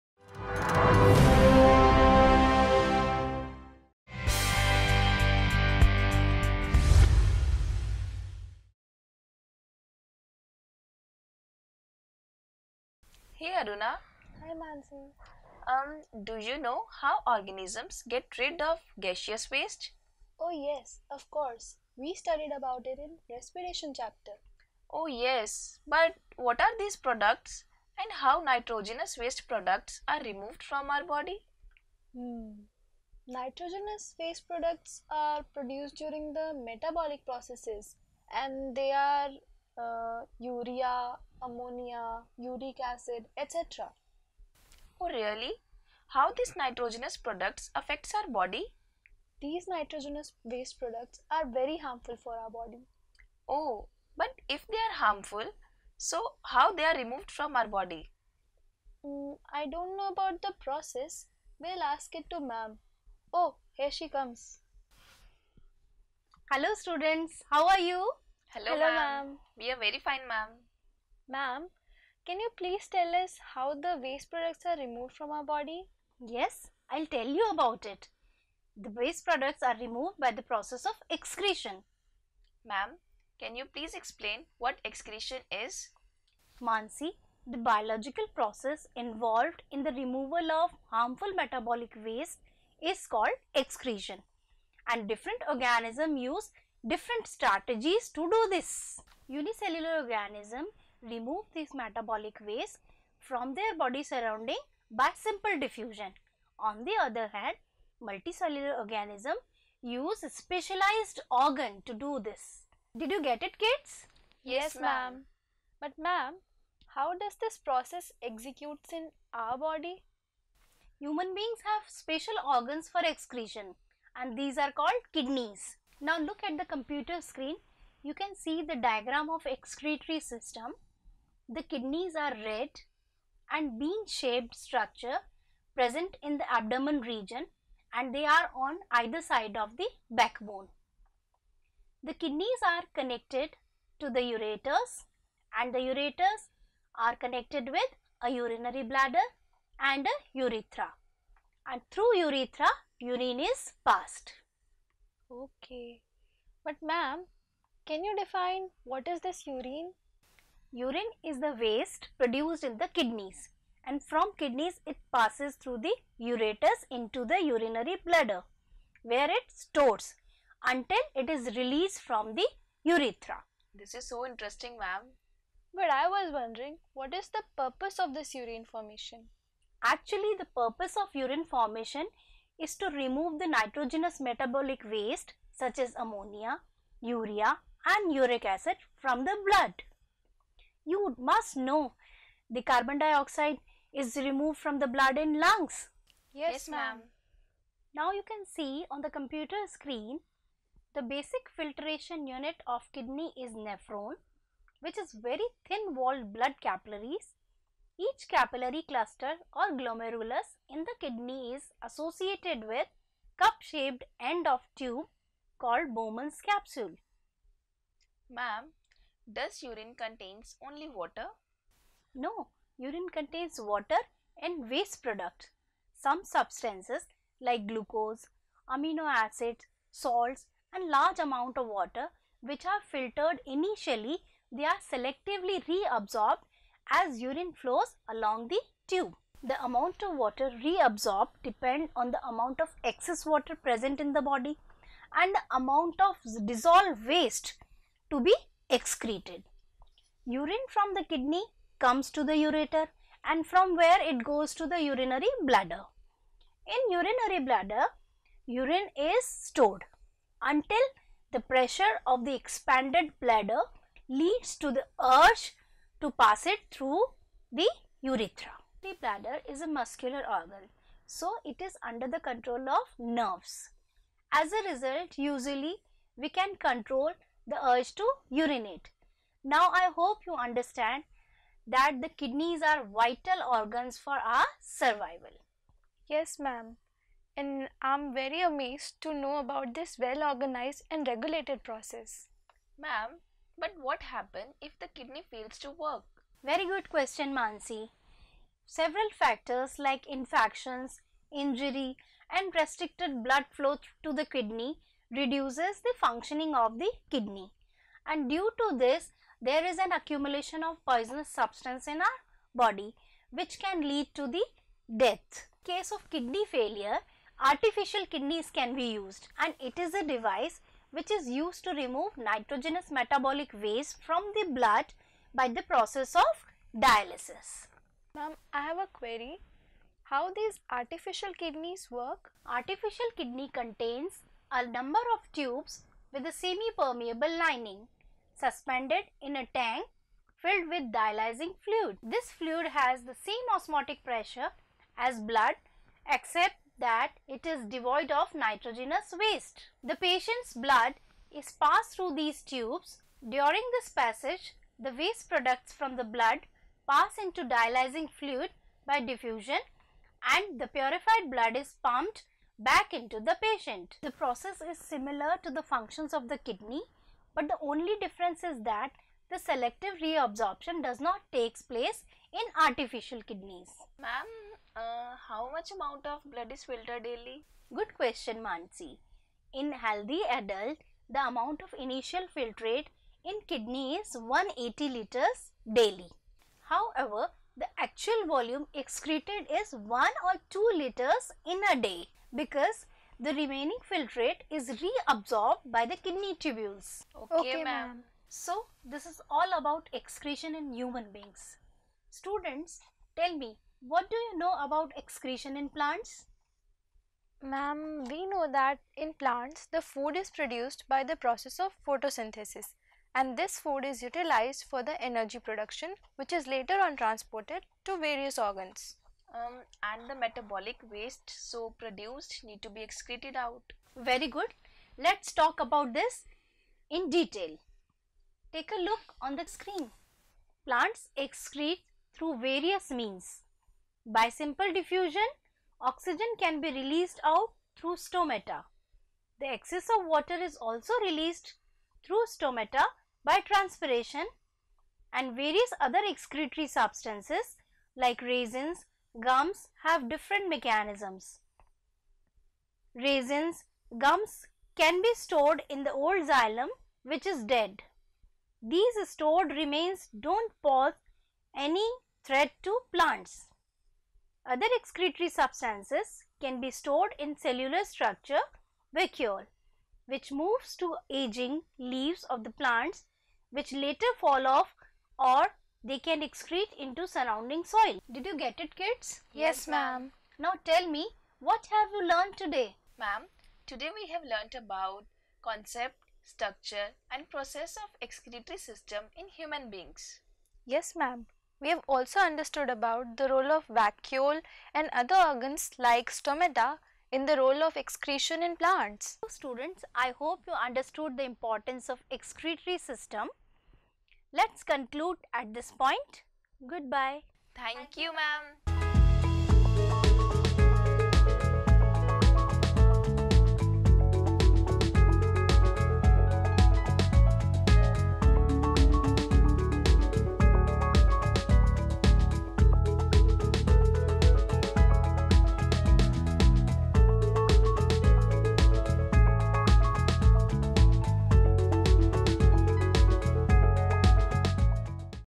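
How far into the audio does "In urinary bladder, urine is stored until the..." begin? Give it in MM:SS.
04:16.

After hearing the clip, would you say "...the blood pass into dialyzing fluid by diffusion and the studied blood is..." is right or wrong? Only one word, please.
wrong.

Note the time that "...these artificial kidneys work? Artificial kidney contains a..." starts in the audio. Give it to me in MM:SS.
05:30.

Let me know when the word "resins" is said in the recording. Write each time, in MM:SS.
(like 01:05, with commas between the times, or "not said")
07:28, 07:32.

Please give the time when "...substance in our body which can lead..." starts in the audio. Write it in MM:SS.
05:11.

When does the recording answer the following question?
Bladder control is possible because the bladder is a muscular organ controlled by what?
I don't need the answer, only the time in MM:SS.
04:32.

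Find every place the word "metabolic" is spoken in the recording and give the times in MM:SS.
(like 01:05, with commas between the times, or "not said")
00:36, 01:31, 01:41, 03:04, 05:22, 07:00.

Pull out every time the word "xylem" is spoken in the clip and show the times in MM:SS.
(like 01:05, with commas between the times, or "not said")
07:36.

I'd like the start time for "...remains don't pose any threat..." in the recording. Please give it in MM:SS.
07:39.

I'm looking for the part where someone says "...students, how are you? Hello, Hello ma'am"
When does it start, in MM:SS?
01:06.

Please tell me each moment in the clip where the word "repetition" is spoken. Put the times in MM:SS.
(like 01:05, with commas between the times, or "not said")
not said.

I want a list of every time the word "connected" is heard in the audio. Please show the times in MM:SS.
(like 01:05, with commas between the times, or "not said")
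02:22, 02:27.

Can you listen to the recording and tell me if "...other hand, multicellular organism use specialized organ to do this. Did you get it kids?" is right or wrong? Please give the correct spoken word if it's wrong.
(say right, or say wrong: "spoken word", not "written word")
right.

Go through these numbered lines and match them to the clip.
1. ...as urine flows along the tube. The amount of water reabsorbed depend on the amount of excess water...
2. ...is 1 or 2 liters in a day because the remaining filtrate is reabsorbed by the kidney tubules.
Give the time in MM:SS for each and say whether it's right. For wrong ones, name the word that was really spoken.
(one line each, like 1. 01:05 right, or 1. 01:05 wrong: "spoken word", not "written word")
1. 03:56 right
2. 06:29 right.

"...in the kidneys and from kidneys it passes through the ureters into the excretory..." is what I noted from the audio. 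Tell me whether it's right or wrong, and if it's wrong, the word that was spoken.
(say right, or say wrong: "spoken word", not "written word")
wrong: "urinary", not "excretory".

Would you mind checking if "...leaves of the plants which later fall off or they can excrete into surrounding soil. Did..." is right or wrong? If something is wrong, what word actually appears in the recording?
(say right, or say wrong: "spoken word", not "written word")
right.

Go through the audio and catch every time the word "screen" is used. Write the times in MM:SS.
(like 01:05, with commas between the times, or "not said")
02:07, 03:19, 07:09.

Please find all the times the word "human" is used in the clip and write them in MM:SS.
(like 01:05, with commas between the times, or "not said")
02:00, 06:40, 08:09.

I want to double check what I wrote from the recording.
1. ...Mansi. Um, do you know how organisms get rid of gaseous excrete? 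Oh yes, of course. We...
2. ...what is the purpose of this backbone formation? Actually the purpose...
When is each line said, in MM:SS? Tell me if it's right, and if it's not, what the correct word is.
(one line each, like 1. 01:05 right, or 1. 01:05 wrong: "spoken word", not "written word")
1. 00:14 wrong: "waste", not "excrete"
2. 02:56 wrong: "urine", not "backbone".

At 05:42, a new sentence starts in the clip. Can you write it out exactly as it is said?
This fluid has the same osmotic pressure as blood except that it is devoid of nitrogenous waste.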